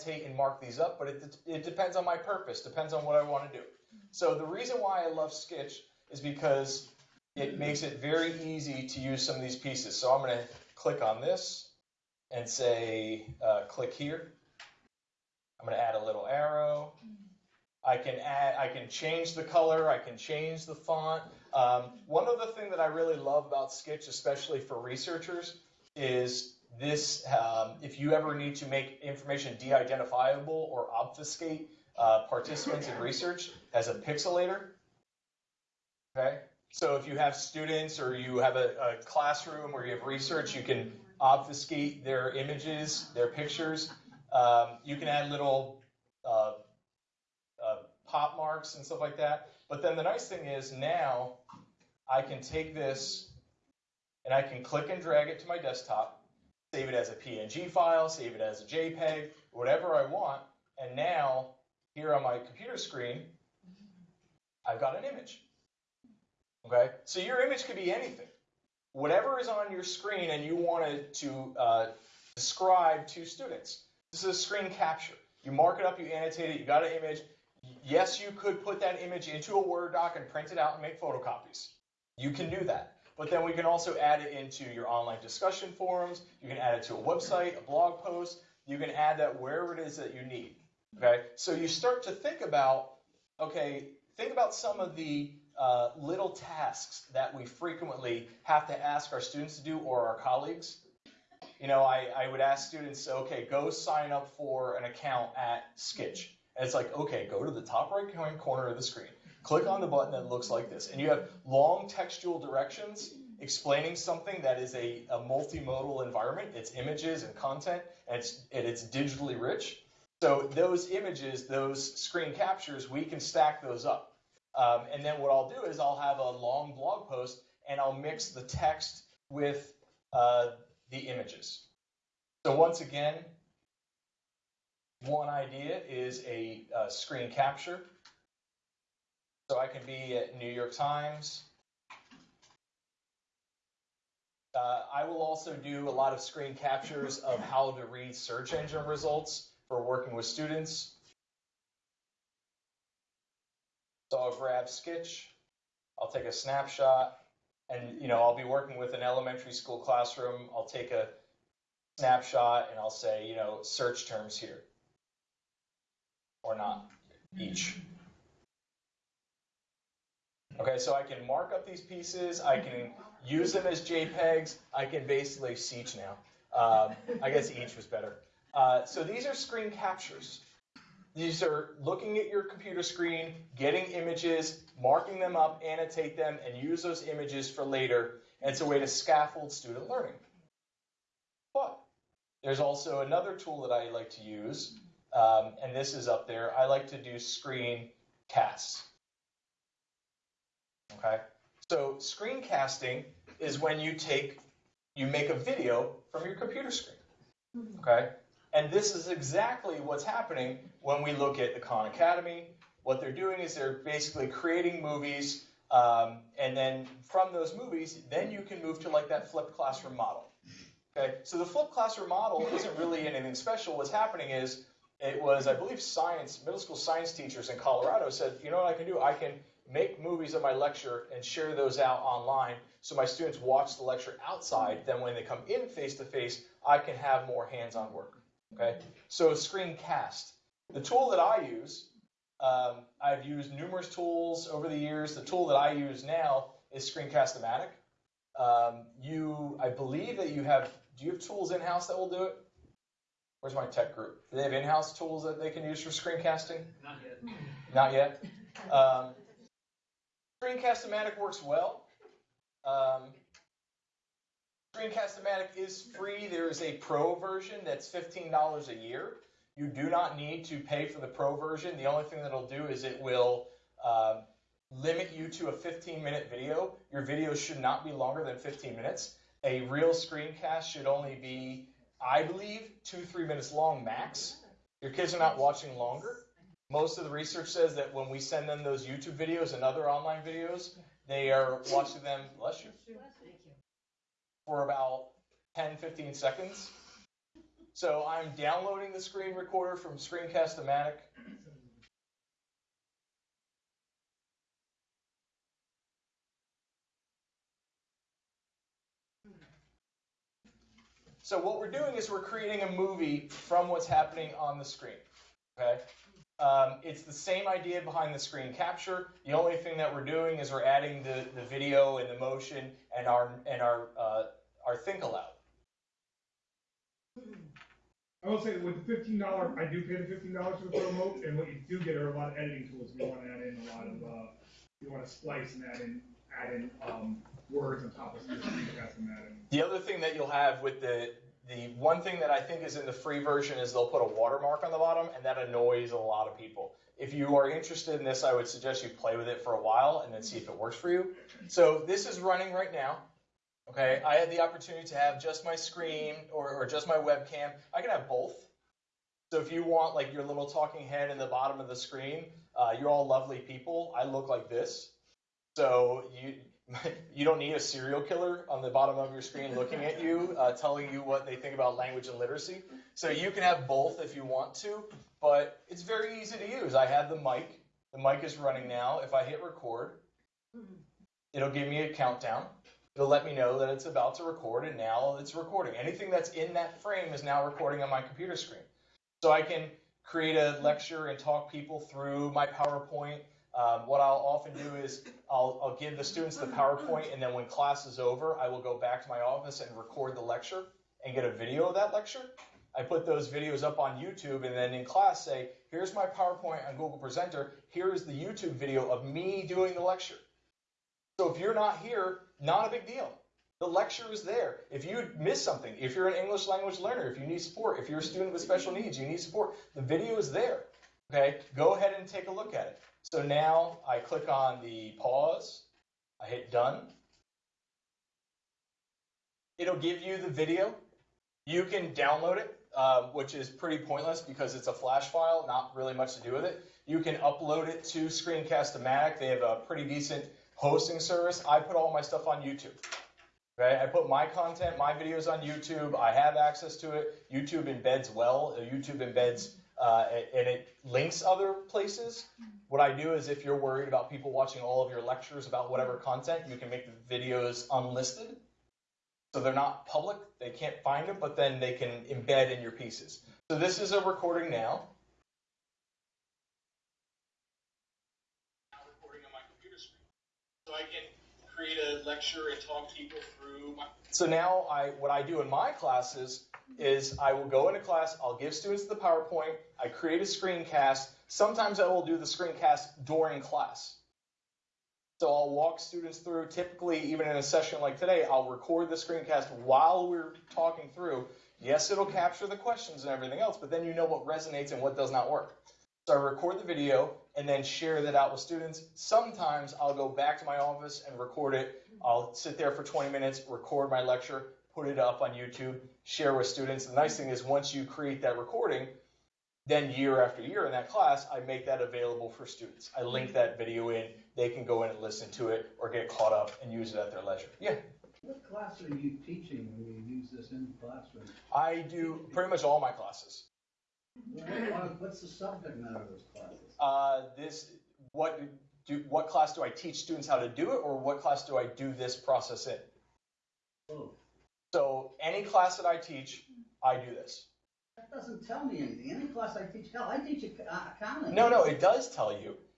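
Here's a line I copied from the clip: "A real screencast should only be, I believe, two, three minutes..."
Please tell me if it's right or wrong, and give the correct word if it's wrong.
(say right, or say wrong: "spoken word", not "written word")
right.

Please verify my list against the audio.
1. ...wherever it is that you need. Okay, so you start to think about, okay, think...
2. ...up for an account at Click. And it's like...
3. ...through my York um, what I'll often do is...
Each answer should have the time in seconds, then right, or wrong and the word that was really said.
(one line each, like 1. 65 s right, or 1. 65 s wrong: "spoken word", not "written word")
1. 89 s right
2. 104 s wrong: "Skitch", not "Click"
3. 391 s wrong: "PowerPoint", not "York".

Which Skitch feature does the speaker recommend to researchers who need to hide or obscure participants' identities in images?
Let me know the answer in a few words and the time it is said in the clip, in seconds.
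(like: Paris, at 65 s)
pixelator, at 33 s.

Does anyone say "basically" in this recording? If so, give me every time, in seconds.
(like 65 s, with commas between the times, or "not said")
175 s, 213 s.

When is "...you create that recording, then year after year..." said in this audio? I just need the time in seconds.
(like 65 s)
507 s.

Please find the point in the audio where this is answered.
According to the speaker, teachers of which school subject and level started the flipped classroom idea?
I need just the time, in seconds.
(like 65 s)
226 s.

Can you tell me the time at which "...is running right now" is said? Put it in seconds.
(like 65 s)
352 s.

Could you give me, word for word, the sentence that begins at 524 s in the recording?
What's the subject matter of those classes?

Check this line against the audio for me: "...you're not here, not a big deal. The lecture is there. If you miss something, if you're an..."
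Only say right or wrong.
right.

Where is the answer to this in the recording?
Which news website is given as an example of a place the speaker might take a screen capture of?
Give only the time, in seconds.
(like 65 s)
140 s.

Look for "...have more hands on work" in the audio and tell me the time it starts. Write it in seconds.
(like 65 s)
236 s.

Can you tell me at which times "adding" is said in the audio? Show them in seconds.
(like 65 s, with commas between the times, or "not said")
320 s.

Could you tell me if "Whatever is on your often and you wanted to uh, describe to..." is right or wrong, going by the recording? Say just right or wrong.
wrong.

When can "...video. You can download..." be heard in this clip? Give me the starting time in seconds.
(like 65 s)
430 s.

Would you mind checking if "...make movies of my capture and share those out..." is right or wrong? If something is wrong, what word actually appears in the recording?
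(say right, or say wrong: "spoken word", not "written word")
wrong: "lecture", not "capture".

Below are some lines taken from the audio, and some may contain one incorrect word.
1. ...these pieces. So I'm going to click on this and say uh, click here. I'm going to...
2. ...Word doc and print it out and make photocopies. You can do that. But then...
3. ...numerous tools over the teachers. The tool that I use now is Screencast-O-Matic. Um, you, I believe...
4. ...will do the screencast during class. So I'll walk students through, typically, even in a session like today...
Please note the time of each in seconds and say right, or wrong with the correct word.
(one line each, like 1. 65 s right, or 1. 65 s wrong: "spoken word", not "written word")
1. 9 s right
2. 79 s right
3. 243 s wrong: "years", not "teachers"
4. 481 s right.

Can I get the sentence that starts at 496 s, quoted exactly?
So I record the video, and then share that out with students.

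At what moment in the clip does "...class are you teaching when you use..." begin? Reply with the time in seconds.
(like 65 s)
518 s.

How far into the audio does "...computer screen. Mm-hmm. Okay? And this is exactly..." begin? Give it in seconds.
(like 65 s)
206 s.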